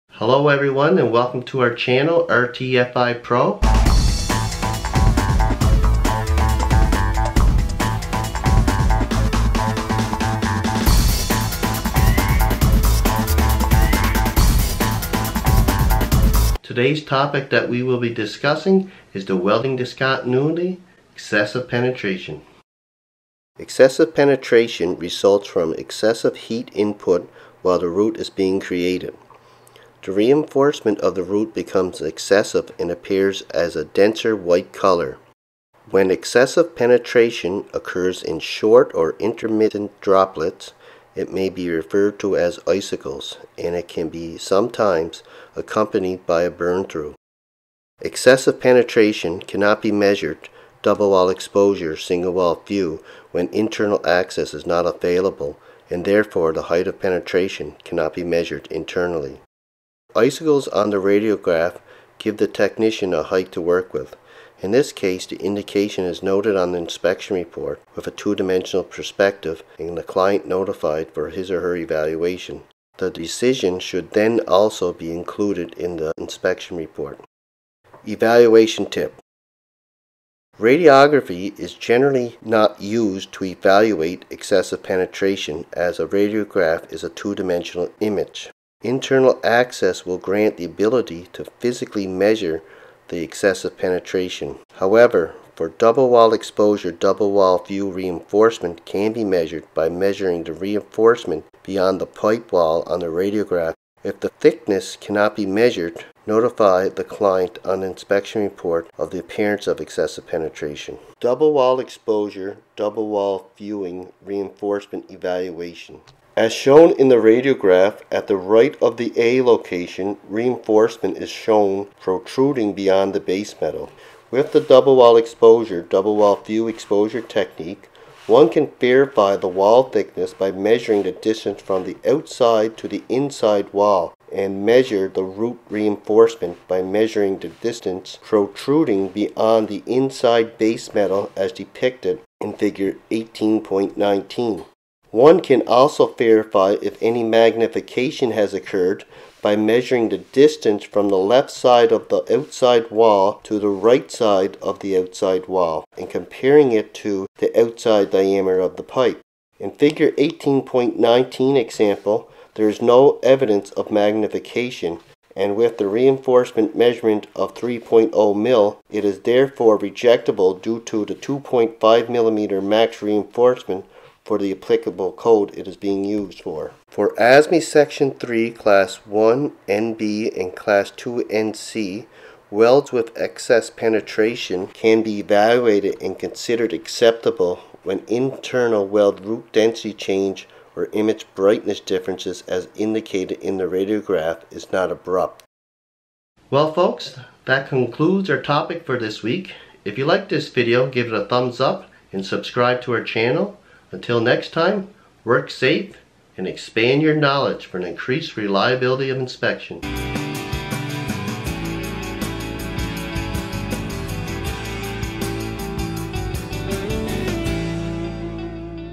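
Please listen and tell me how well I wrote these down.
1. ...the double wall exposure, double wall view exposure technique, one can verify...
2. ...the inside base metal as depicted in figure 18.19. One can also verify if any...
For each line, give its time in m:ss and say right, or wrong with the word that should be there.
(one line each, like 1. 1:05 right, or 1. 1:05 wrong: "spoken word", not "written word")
1. 2:04 right
2. 2:19 right.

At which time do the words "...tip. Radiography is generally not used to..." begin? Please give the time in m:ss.
1:18.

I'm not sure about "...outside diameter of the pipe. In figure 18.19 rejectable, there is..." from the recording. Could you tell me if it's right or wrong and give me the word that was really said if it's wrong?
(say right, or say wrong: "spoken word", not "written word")
wrong: "example", not "rejectable".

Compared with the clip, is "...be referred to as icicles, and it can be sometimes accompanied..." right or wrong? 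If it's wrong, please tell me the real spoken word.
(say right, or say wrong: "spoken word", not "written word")
right.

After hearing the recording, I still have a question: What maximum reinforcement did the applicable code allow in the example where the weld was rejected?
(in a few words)
2.5 millimeters.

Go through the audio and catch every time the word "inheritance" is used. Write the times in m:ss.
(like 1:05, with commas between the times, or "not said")
not said.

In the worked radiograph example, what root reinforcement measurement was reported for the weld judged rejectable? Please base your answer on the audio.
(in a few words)
3.0 mil.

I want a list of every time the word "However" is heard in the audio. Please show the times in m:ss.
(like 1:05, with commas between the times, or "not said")
1:34.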